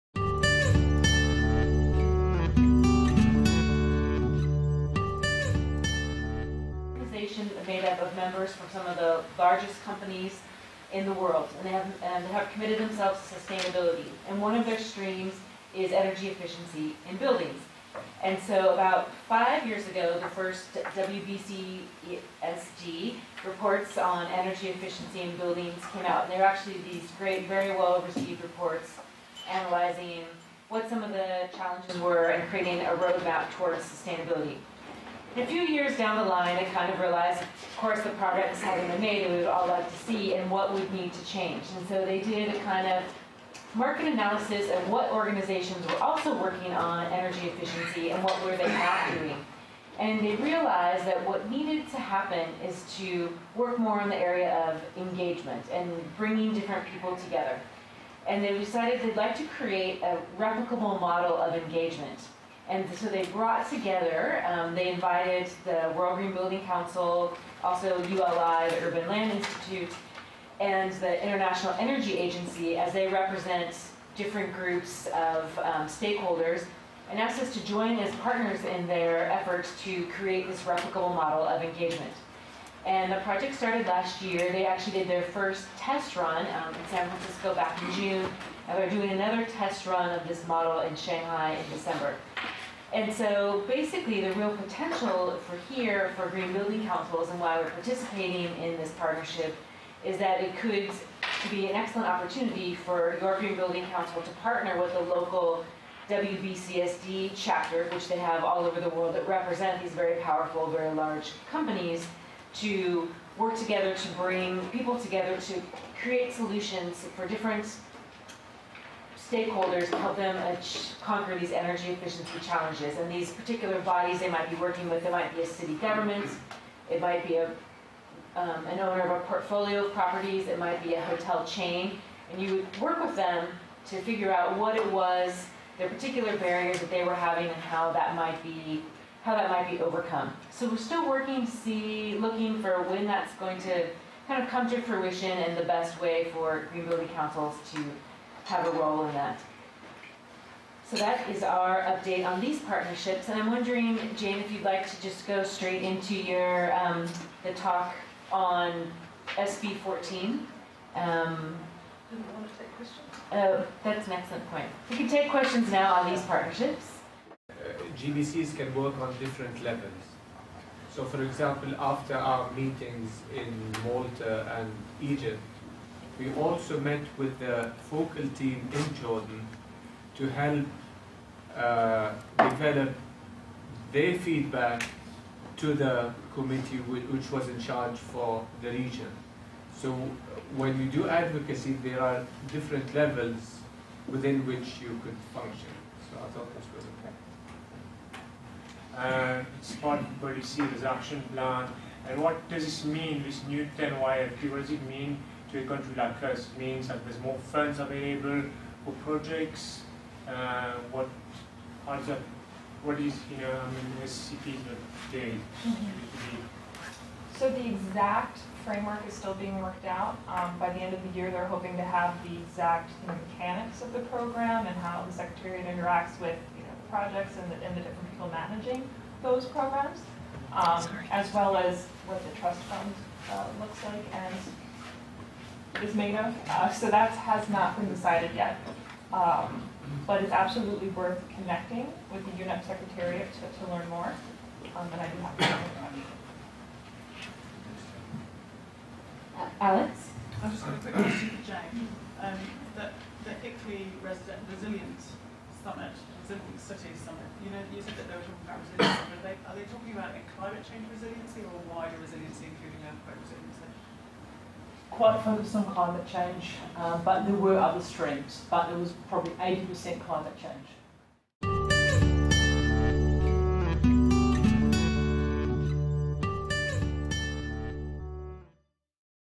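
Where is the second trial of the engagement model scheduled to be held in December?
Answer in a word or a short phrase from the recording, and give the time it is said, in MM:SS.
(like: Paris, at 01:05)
Shanghai, at 01:30.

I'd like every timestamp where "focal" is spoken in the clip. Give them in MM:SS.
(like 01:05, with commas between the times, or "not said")
02:57.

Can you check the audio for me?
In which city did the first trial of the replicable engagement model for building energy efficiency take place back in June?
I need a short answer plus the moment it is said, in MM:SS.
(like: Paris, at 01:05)
San Francisco, at 01:26.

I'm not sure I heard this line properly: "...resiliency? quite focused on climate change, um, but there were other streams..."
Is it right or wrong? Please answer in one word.
right.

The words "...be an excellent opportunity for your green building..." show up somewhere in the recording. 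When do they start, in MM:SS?
01:41.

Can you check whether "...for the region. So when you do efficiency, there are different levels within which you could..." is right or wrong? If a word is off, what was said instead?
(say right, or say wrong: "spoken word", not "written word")
wrong: "advocacy", not "efficiency".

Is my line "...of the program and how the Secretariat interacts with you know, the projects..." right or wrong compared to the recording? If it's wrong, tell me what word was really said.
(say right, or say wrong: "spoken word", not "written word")
right.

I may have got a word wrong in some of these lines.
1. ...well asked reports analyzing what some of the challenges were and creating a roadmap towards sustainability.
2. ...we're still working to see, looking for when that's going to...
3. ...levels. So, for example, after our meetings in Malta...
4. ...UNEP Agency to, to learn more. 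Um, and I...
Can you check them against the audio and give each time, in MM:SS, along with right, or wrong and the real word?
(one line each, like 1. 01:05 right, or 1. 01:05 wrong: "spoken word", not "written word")
1. 00:27 wrong: "received", not "asked"
2. 02:20 right
3. 02:49 right
4. 04:02 wrong: "Secretariat", not "Agency".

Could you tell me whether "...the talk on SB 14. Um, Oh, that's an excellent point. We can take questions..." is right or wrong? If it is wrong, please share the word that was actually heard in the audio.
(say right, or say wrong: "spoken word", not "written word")
right.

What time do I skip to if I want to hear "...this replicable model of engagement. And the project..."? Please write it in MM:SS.
01:20.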